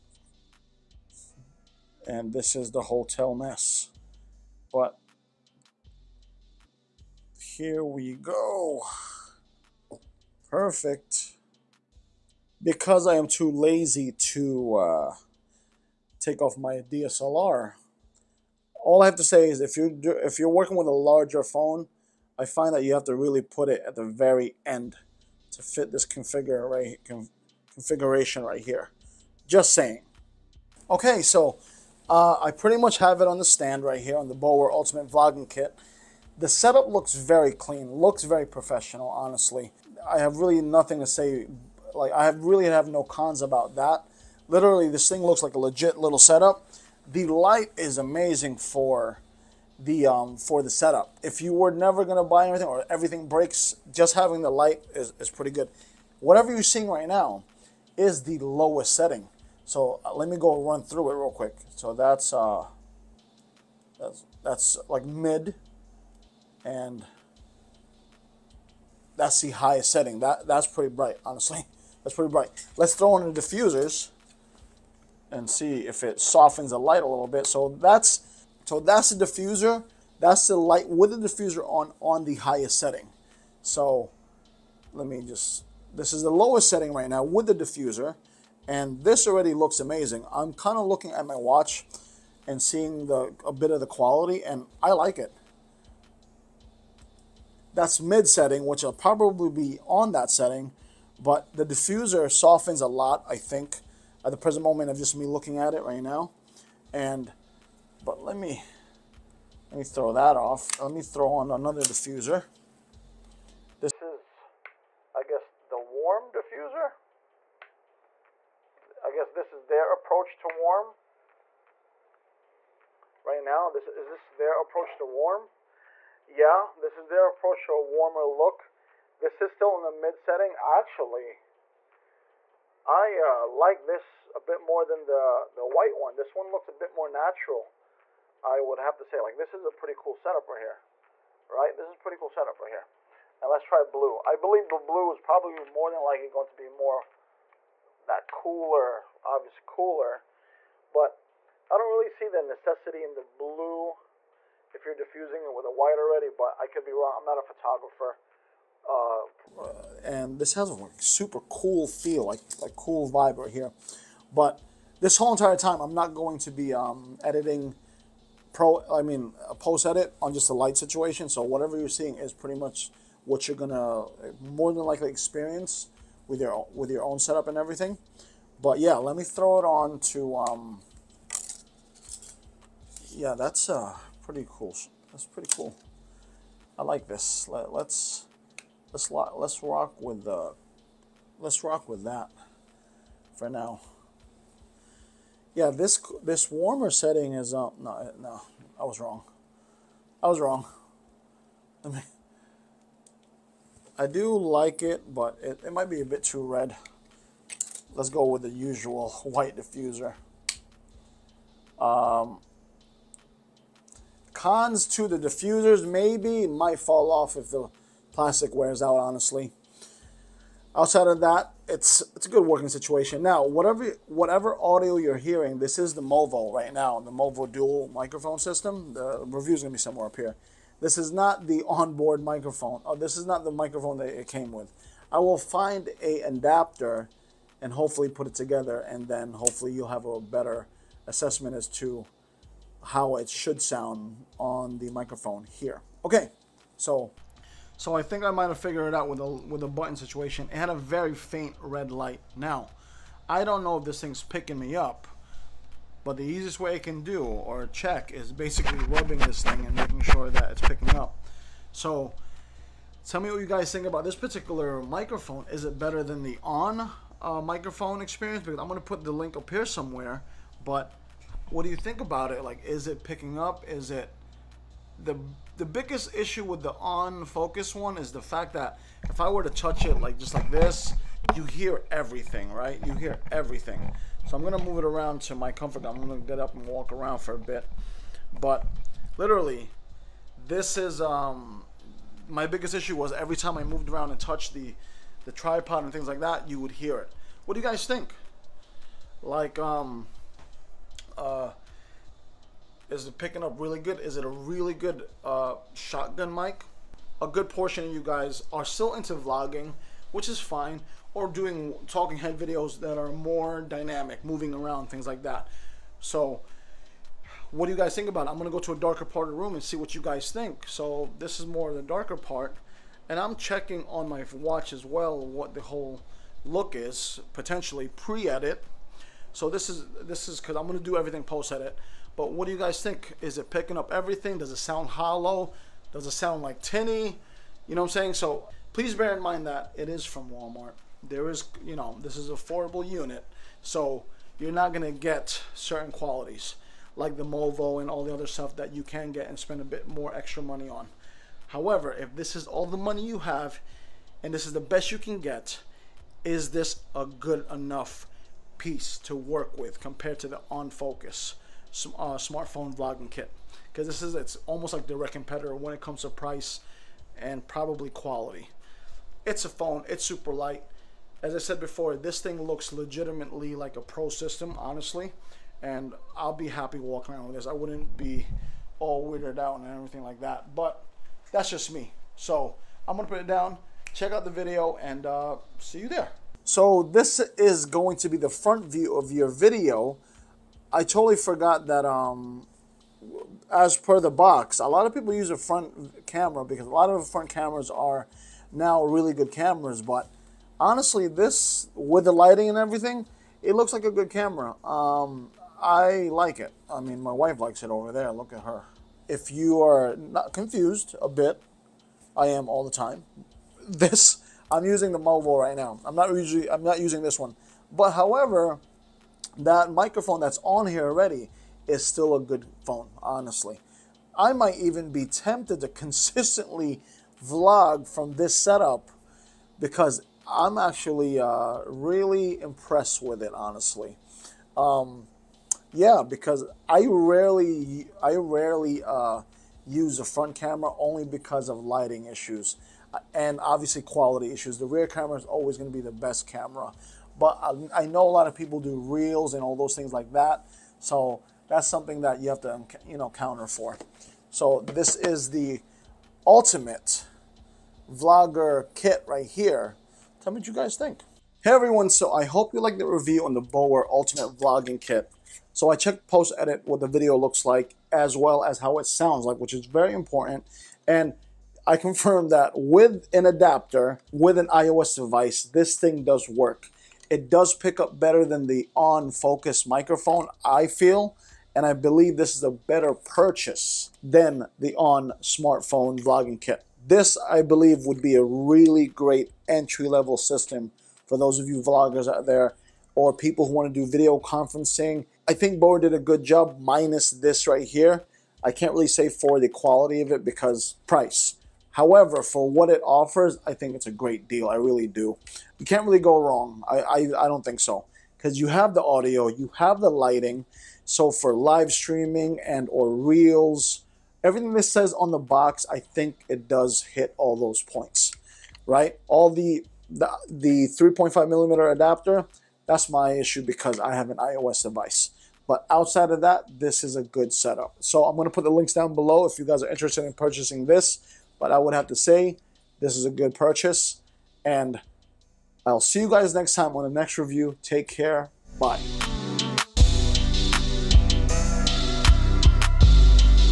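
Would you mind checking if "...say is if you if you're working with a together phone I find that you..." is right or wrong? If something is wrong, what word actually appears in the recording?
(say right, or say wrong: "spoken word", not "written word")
wrong: "larger", not "together".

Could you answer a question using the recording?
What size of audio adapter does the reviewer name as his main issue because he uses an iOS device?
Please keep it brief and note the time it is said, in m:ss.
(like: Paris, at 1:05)
3.5 millimeter, at 8:40.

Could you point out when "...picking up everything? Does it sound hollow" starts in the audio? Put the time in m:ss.
5:33.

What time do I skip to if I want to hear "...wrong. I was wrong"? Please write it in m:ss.
3:18.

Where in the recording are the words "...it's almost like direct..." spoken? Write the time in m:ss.
6:04.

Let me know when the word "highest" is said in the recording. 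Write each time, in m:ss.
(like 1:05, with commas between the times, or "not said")
1:09, 1:22.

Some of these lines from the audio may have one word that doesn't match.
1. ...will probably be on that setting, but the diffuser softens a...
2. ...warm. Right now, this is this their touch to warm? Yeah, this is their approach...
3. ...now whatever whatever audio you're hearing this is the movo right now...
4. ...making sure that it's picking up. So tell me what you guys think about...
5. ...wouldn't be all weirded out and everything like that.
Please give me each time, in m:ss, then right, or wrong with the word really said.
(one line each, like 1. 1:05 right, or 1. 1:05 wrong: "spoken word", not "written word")
1. 1:38 right
2. 2:00 wrong: "approach", not "touch"
3. 3:43 right
4. 4:19 right
5. 6:17 right.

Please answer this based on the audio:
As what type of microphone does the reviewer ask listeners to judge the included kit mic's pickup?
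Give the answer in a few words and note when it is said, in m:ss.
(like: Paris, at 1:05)
shotgun mic, at 5:05.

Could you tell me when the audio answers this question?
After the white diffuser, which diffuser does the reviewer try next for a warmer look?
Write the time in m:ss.
1:55.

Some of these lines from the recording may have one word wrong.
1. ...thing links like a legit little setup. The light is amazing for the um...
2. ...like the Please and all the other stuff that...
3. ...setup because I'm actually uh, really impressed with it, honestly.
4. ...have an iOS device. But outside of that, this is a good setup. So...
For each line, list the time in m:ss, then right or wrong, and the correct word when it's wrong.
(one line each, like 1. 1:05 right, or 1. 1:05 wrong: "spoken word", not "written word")
1. 0:45 wrong: "looks", not "links"
2. 5:46 wrong: "Movo", not "Please"
3. 7:08 right
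4. 8:43 right.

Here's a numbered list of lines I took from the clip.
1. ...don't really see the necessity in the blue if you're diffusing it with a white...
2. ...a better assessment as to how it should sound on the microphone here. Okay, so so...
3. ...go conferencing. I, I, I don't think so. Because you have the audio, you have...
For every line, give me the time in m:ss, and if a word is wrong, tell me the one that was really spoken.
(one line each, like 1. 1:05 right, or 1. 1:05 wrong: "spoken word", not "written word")
1. 2:31 right
2. 4:00 right
3. 8:25 wrong: "wrong", not "conferencing".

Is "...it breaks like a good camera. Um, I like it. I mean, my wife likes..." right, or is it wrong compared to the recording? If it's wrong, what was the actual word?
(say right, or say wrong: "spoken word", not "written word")
wrong: "looks", not "breaks".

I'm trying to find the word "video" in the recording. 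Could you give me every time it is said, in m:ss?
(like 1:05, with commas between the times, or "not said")
5:12, 6:24, 6:29, 7:46, 8:13.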